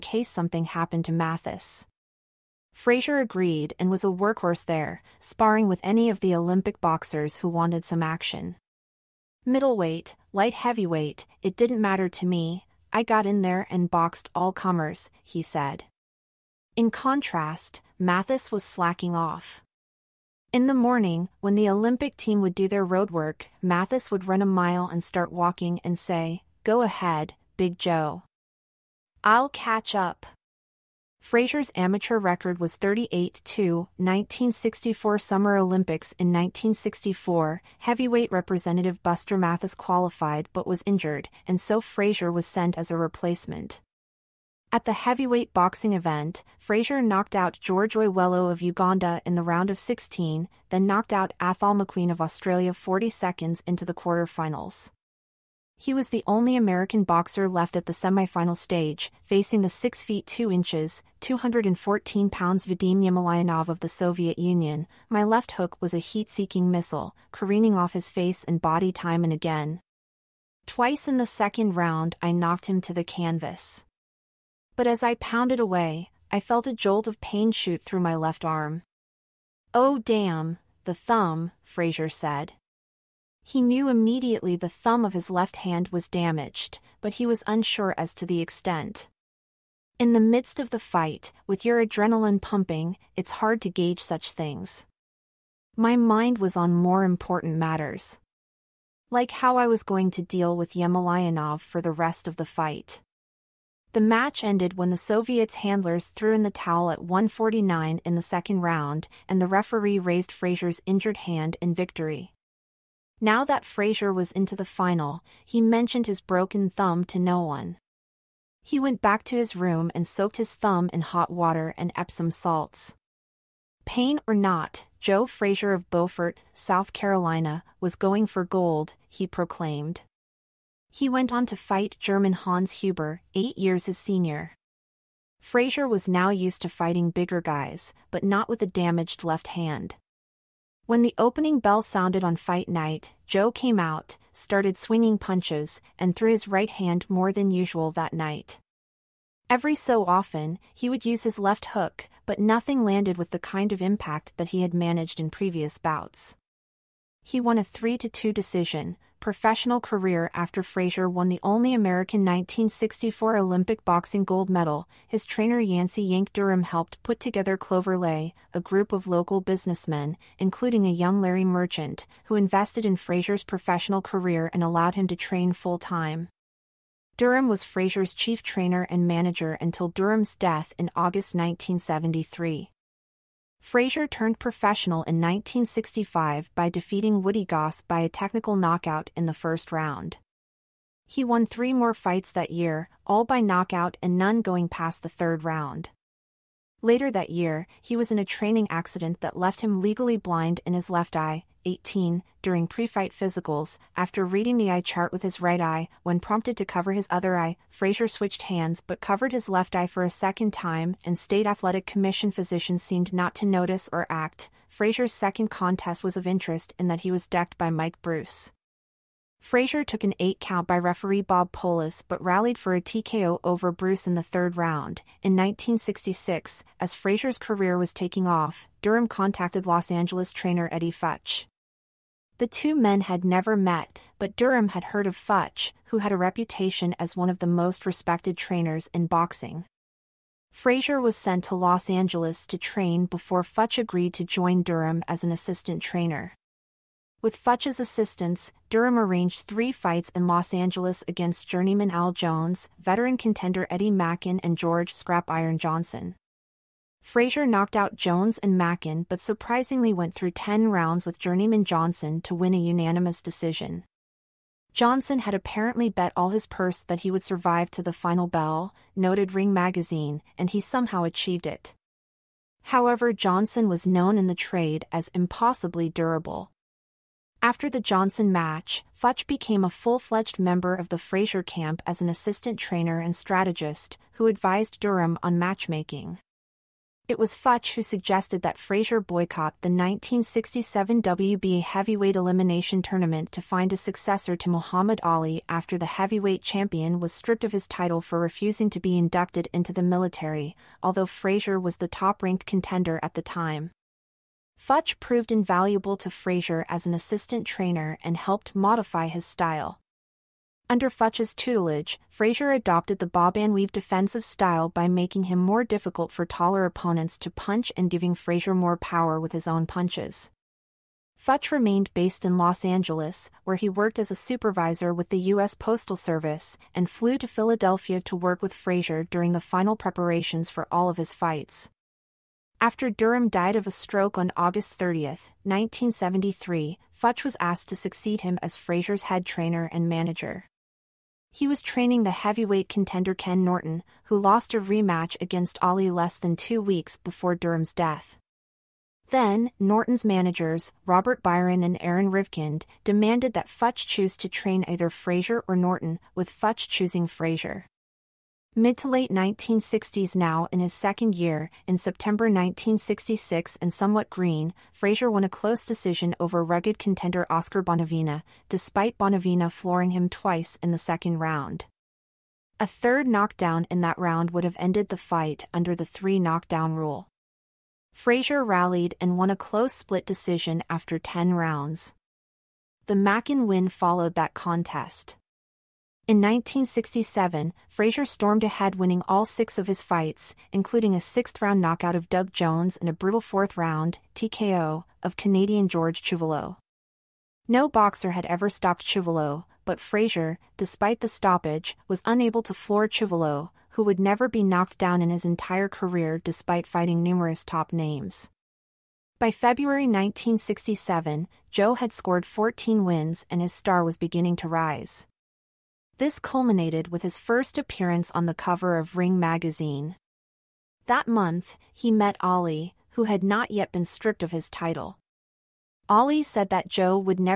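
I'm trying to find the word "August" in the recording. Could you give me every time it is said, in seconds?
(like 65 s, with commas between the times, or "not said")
180 s, 334 s.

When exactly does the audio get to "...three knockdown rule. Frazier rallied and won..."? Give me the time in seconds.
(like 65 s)
375 s.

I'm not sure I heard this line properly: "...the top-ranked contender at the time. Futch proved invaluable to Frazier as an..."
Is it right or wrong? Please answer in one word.
right.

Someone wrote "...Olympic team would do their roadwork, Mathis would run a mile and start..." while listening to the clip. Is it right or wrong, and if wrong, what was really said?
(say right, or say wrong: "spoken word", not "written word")
right.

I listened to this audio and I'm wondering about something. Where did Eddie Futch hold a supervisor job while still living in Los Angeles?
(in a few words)
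U.S. Postal Service.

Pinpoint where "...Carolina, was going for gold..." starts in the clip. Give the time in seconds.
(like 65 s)
126 s.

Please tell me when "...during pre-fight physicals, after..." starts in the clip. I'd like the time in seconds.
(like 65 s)
202 s.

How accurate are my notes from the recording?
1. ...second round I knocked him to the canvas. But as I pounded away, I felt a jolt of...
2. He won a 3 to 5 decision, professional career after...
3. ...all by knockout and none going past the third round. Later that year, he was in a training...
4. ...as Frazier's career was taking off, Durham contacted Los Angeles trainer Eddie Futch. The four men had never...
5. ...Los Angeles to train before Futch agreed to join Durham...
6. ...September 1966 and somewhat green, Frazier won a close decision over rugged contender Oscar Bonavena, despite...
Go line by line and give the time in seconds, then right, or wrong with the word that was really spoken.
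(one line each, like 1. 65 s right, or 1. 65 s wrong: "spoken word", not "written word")
1. 71 s right
2. 157 s wrong: "2", not "5"
3. 193 s right
4. 226 s wrong: "two", not "four"
5. 241 s right
6. 361 s right.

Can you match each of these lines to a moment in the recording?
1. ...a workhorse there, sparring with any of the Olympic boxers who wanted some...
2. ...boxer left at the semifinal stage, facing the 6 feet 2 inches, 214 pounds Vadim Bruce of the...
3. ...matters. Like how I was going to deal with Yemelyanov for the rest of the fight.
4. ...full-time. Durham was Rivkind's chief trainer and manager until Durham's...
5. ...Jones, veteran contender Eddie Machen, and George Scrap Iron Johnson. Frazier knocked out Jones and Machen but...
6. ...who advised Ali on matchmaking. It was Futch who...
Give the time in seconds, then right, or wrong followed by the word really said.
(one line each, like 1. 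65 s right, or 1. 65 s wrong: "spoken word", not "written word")
1. 4 s right
2. 57 s wrong: "Yemelyanov", not "Bruce"
3. 97 s right
4. 175 s wrong: "Frazier", not "Rivkind"
5. 252 s right
6. 284 s wrong: "Durham", not "Ali".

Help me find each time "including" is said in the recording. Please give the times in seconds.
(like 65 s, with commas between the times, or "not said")
170 s, 390 s.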